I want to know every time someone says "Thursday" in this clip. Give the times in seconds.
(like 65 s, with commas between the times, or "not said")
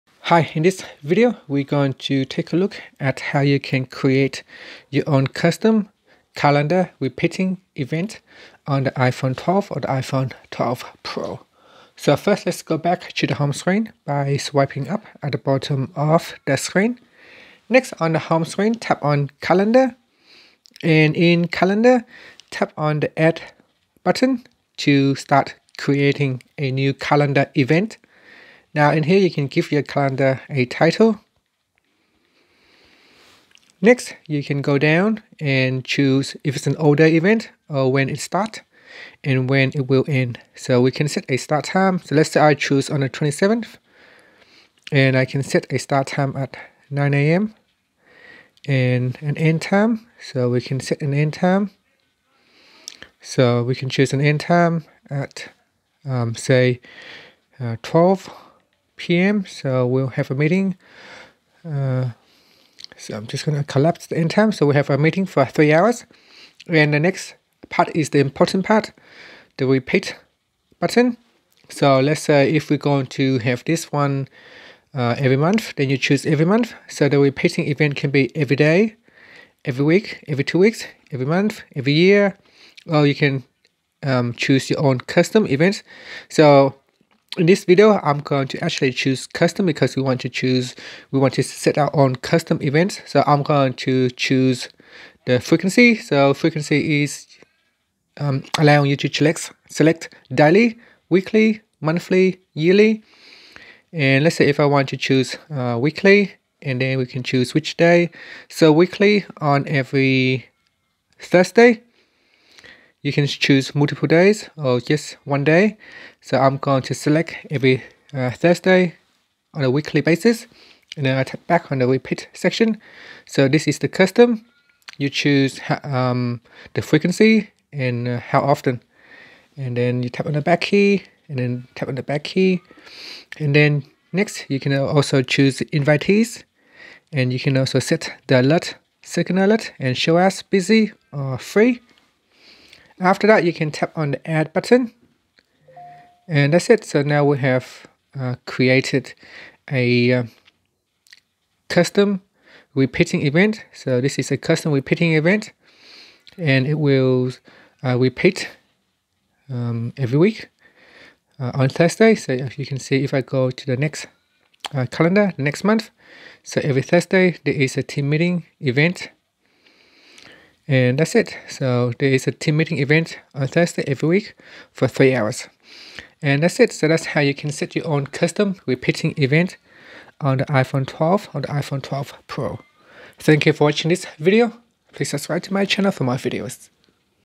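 111 s, 118 s, 161 s, 166 s, 173 s.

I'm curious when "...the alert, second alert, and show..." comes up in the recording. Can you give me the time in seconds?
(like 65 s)
138 s.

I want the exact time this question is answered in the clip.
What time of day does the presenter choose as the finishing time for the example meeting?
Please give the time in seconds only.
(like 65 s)
57 s.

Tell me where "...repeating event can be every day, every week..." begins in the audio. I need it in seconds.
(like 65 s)
77 s.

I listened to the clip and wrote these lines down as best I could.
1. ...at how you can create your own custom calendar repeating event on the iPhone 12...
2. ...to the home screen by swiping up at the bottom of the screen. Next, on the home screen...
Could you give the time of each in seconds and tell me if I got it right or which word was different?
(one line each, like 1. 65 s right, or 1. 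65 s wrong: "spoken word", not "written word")
1. 3 s right
2. 13 s right.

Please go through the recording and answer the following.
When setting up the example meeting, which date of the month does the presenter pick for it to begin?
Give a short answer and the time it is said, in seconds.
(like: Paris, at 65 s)
27th, at 43 s.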